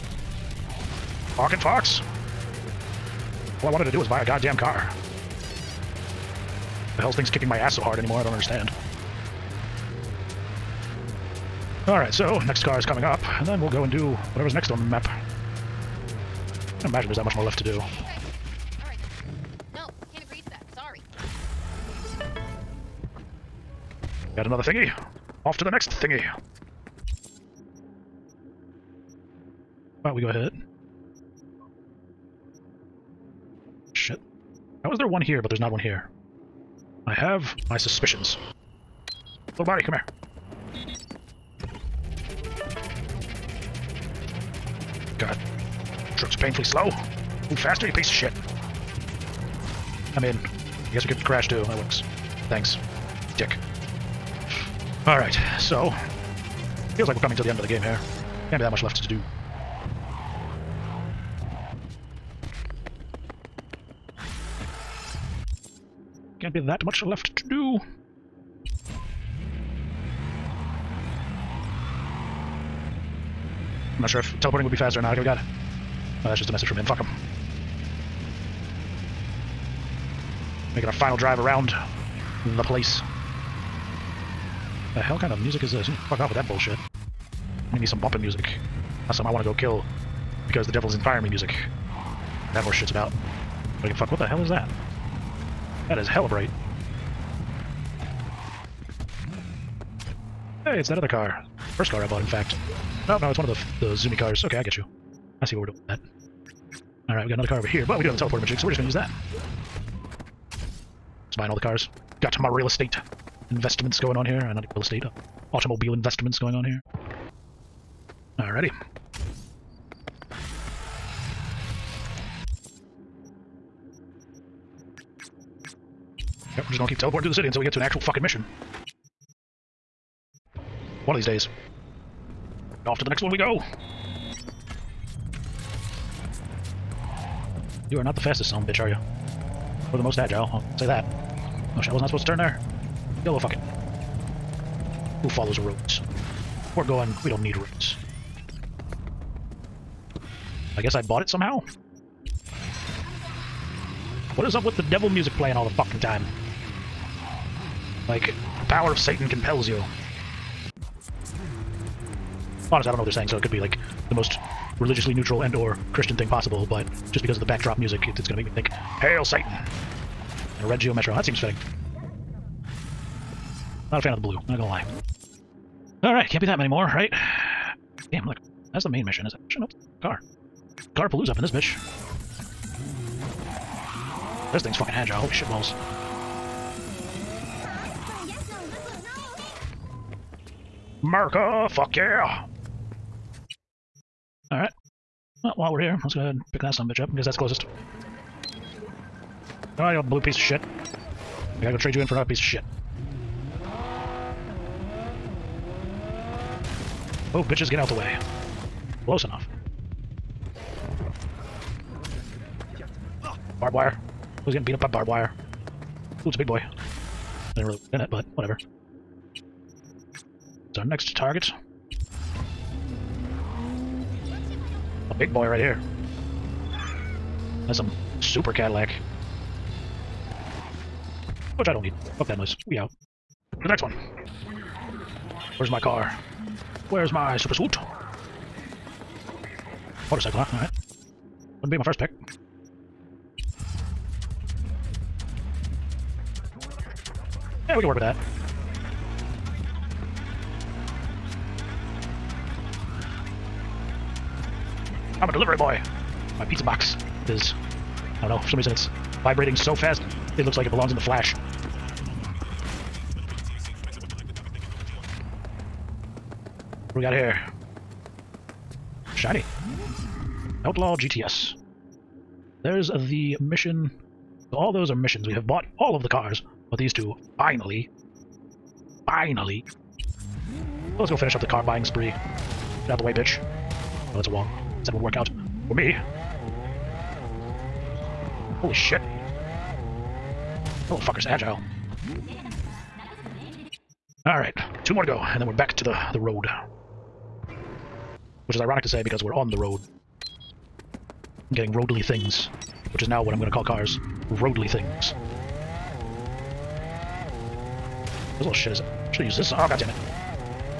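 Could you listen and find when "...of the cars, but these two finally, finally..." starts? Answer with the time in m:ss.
4:35.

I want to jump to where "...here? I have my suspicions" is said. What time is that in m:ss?
0:35.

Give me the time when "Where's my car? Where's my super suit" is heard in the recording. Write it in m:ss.
3:55.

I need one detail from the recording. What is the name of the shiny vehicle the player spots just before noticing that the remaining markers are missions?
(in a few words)
Outlaw GTS.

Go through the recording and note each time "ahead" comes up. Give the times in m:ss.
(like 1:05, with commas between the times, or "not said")
0:30, 3:16.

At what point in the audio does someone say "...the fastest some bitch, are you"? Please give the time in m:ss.
2:18.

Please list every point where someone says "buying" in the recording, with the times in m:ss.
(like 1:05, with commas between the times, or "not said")
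1:51, 4:41.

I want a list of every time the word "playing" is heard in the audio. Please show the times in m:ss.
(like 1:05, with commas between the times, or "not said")
2:35.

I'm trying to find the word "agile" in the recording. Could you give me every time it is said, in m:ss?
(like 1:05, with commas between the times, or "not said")
2:20, 3:04, 4:51.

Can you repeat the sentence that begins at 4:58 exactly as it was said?
Which is ironic to say because we're on the road.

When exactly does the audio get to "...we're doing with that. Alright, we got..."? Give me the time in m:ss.
1:45.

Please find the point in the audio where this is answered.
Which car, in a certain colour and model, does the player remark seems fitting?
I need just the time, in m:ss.
2:50.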